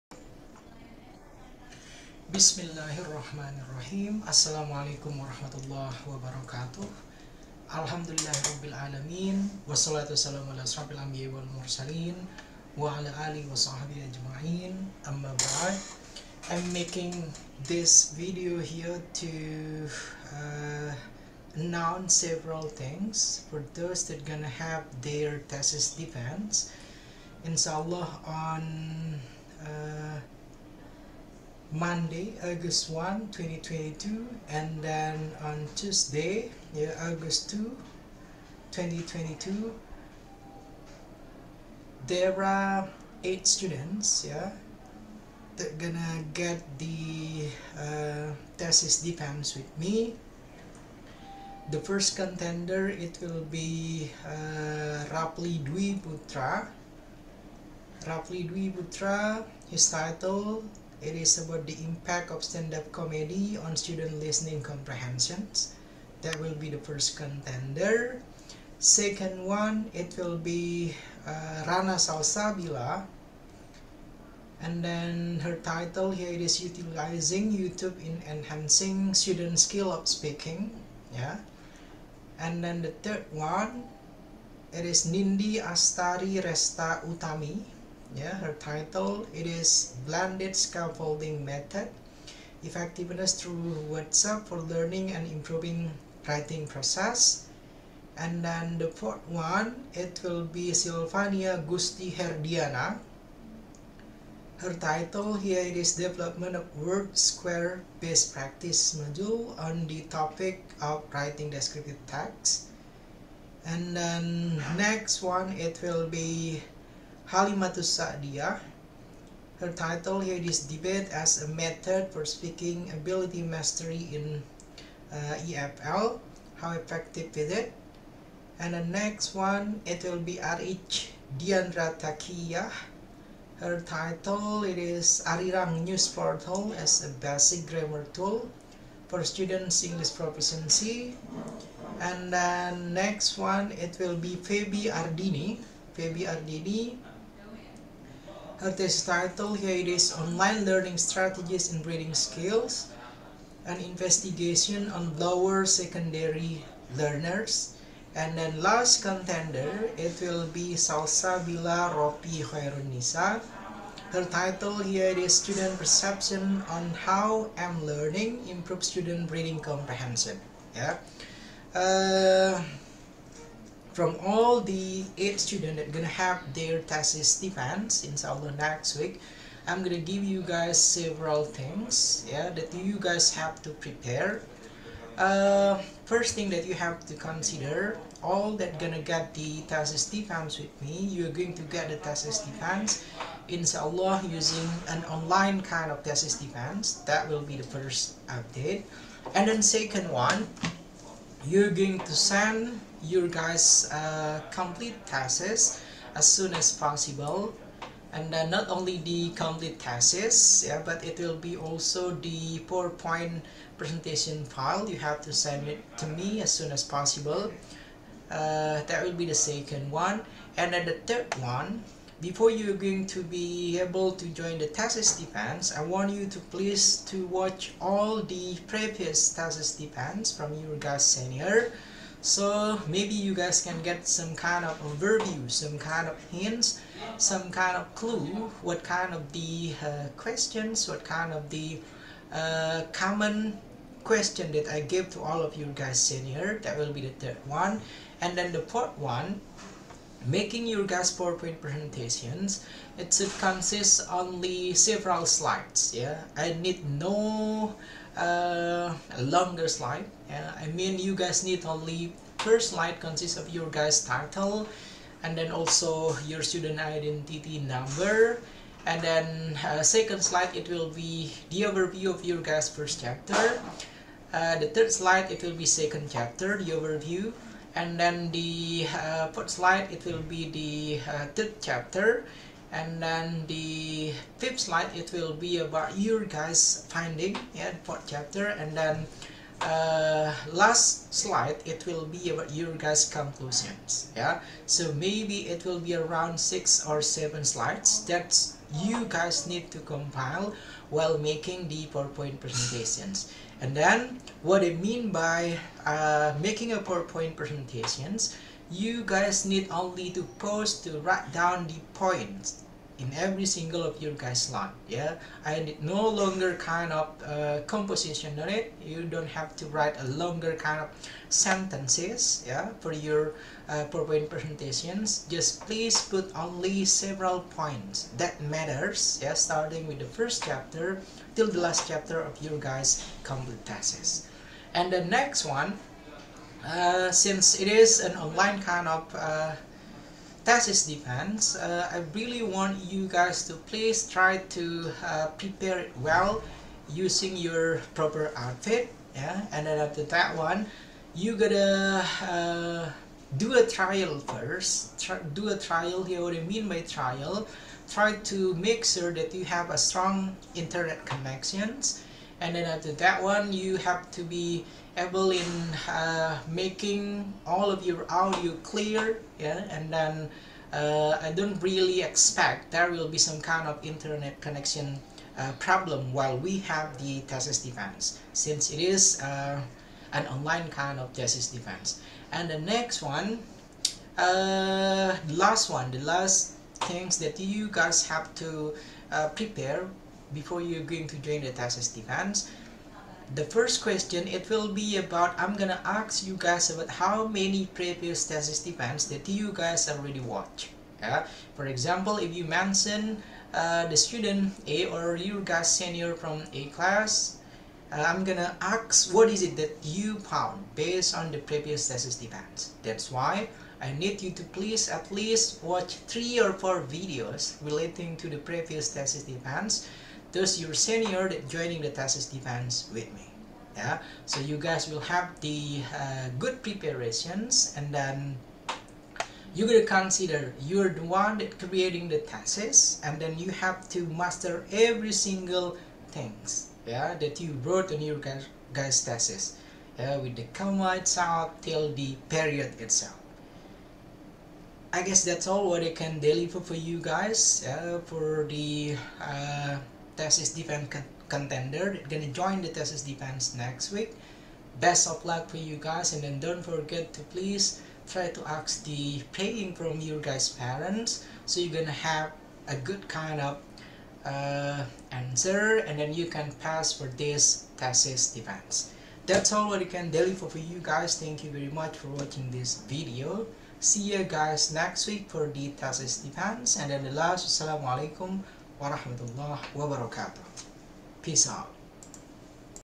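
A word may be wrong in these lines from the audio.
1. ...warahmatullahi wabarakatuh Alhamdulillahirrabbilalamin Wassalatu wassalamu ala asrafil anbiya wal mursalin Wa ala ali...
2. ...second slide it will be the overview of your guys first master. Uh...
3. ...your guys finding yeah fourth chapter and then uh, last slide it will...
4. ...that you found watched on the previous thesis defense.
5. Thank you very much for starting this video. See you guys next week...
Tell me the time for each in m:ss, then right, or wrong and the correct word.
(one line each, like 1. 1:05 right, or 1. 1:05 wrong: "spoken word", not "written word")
1. 0:05 right
2. 4:29 wrong: "chapter", not "master"
3. 4:45 right
4. 6:49 wrong: "based", not "watched"
5. 7:51 wrong: "watching", not "starting".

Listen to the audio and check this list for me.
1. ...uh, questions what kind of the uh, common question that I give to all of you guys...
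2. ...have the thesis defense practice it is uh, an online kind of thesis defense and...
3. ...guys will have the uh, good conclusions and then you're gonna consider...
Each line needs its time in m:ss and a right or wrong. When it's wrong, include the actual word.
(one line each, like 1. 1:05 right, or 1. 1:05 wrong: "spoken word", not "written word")
1. 3:59 right
2. 6:16 wrong: "since", not "practice"
3. 7:04 wrong: "preparations", not "conclusions".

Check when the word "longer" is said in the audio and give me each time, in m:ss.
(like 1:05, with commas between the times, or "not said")
4:19, 5:16, 5:20.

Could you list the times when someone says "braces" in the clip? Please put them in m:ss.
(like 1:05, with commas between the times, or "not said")
not said.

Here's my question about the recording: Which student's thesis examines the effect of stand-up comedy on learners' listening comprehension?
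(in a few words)
Rapli Dwi Putra.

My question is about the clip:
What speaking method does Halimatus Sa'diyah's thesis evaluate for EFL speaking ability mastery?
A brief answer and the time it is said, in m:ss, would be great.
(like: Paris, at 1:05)
Debate, at 2:00.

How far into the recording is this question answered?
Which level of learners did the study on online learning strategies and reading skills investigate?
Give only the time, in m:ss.
2:35.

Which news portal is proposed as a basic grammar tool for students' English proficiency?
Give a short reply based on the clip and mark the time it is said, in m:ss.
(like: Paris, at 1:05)
Arirang News, at 2:15.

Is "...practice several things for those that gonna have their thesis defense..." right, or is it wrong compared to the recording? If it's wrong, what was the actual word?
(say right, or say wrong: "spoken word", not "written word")
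wrong: "announce", not "practice".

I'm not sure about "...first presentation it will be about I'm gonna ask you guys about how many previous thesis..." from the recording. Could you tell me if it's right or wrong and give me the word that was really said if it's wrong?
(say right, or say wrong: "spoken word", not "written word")
wrong: "question", not "presentation".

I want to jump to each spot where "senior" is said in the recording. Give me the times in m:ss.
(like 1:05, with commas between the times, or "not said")
3:51, 6:45, 7:00.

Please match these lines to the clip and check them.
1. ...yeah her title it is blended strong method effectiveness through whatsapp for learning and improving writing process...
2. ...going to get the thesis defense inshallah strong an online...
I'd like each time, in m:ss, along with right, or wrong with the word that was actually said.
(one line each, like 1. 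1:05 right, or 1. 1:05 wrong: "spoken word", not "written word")
1. 1:28 wrong: "scaffolding", not "strong"
2. 3:11 wrong: "using", not "strong".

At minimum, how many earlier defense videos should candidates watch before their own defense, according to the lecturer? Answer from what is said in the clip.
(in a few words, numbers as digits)
3.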